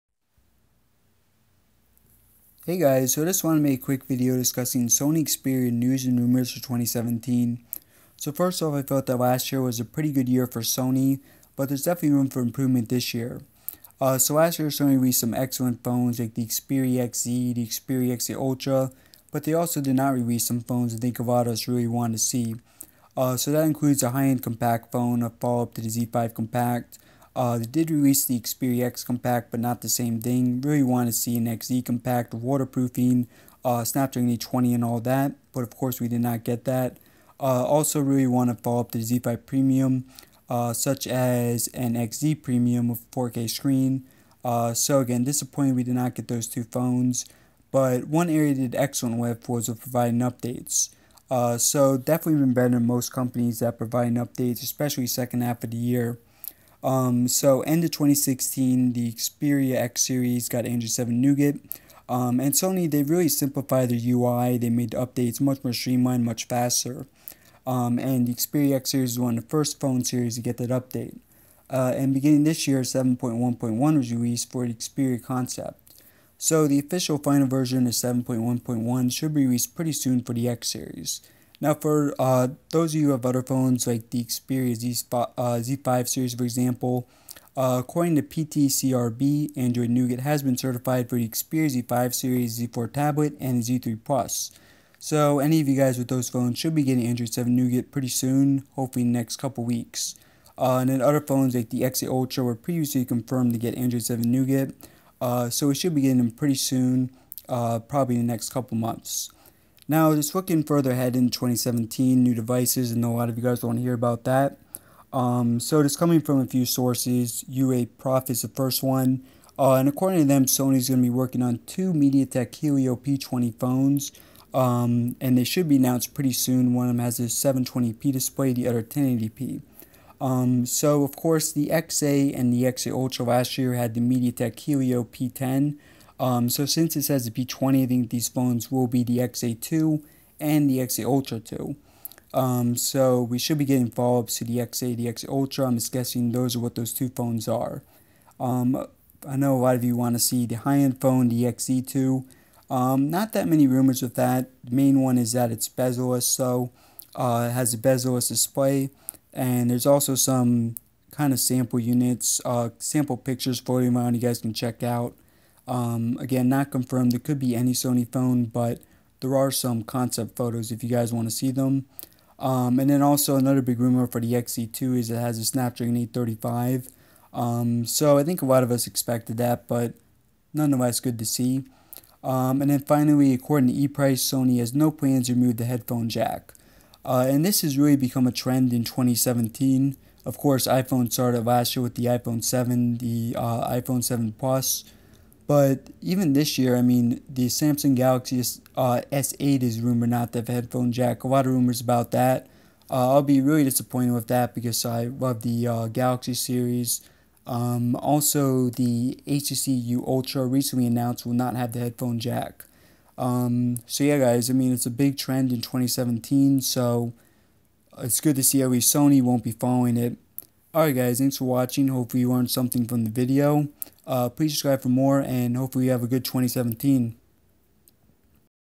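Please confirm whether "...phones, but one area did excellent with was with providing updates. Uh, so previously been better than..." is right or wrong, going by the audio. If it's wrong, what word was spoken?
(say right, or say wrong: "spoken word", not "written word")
wrong: "definitely", not "previously".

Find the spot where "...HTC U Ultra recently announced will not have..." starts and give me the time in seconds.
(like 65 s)
209 s.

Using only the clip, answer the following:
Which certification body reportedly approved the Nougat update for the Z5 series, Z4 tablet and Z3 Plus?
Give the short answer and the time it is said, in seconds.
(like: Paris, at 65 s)
PTCRB, at 88 s.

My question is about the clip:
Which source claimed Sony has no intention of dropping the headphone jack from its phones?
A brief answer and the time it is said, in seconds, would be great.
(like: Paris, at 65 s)
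ePrice, at 183 s.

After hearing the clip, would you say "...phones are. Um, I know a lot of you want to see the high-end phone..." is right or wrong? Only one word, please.
right.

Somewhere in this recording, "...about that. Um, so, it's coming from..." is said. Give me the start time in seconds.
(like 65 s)
113 s.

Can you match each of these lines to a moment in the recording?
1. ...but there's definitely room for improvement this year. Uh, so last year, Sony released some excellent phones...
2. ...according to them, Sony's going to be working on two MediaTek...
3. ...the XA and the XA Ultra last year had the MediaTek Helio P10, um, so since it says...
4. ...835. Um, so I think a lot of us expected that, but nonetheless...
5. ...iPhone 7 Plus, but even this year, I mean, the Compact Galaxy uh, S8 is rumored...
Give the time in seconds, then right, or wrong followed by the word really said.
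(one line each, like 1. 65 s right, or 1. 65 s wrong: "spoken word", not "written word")
1. 11 s right
2. 119 s right
3. 131 s right
4. 175 s right
5. 193 s wrong: "Samsung", not "Compact".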